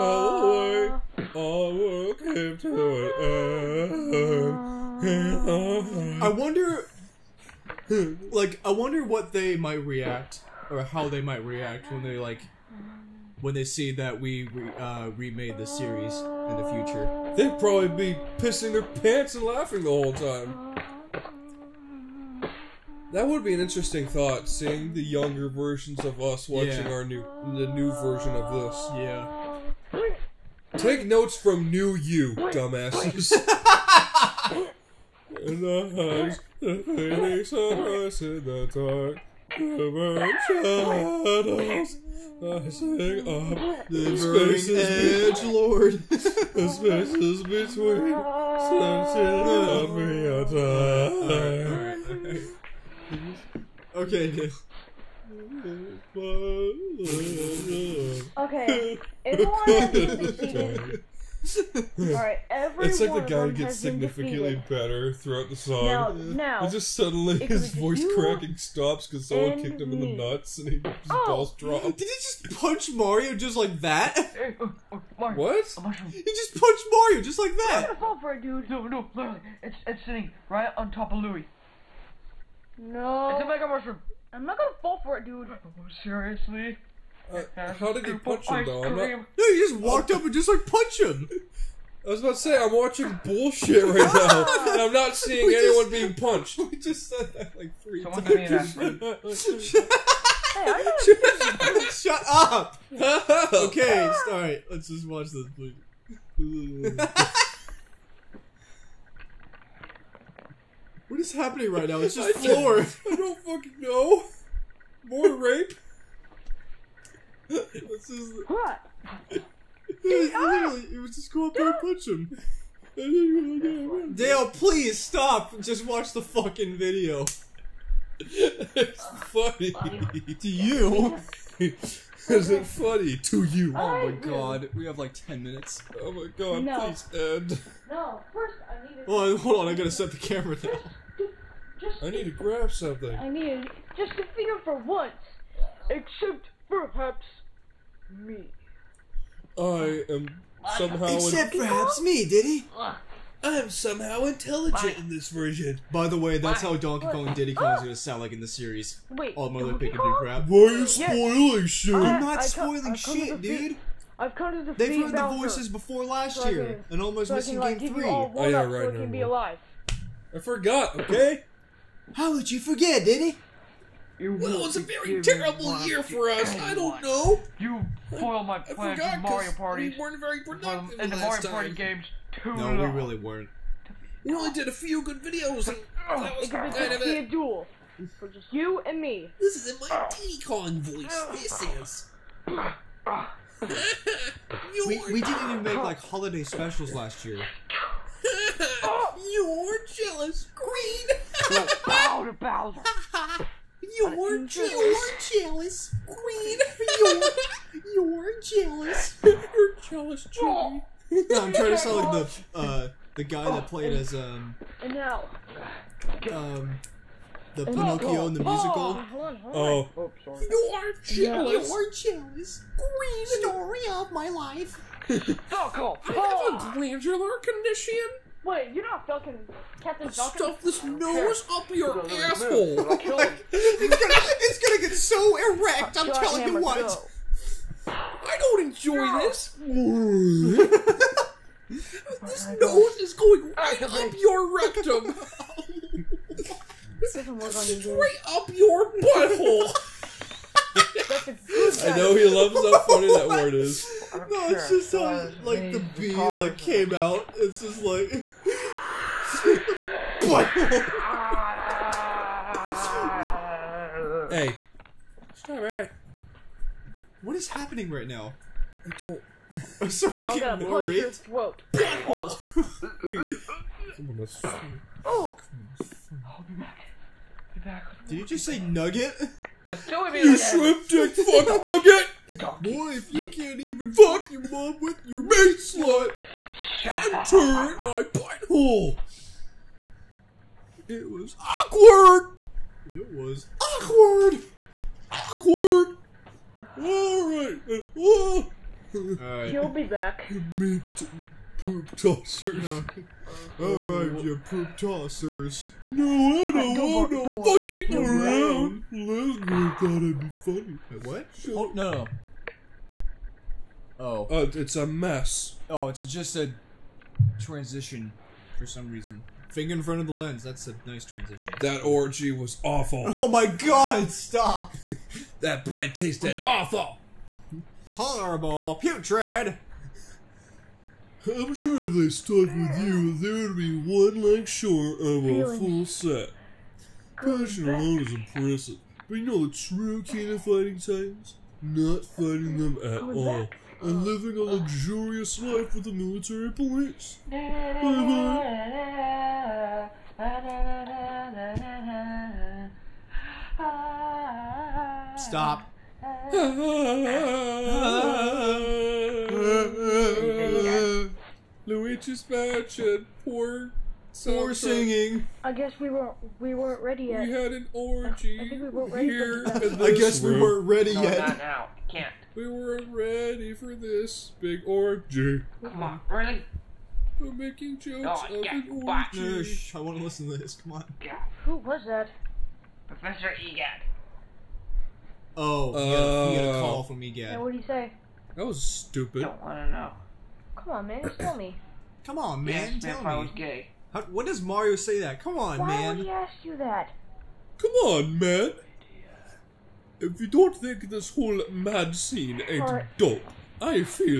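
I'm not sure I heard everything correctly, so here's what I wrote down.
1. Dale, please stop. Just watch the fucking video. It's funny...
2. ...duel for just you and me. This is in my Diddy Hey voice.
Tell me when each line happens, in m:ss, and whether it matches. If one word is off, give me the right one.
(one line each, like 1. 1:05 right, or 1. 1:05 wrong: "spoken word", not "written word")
1. 2:04 right
2. 3:07 wrong: "Kong", not "Hey".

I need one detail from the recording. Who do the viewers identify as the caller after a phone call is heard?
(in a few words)
Professor Egad.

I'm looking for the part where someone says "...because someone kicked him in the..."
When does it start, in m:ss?
1:09.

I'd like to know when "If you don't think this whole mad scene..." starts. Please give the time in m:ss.
6:39.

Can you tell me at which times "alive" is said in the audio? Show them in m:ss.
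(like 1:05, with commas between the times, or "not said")
2:49.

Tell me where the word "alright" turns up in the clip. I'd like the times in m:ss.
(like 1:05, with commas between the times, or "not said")
1:01, 1:44, 4:25, 4:56, 5:03.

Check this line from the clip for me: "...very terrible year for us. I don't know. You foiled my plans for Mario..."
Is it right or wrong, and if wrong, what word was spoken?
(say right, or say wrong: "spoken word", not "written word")
right.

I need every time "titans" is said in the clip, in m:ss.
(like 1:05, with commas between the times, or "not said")
5:40.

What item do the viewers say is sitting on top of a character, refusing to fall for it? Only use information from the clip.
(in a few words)
mega mushroom.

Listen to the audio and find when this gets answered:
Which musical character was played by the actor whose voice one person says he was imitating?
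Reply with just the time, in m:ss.
3:37.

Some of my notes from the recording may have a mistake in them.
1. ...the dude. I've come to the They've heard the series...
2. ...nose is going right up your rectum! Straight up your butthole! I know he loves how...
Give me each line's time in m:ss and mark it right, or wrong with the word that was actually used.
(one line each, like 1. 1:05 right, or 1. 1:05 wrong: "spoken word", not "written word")
1. 2:43 wrong: "voices", not "series"
2. 4:02 right.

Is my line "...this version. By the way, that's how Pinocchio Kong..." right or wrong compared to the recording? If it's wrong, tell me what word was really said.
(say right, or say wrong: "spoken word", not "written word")
wrong: "Donkey", not "Pinocchio".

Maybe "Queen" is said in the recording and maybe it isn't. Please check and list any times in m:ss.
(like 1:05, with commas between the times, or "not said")
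3:26, 3:42.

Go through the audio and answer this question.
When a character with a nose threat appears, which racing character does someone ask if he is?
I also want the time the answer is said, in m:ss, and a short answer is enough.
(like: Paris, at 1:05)
Captain Falcon, at 3:49.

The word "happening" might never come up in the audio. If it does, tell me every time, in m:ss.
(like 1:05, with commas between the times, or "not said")
1:51, 4:27.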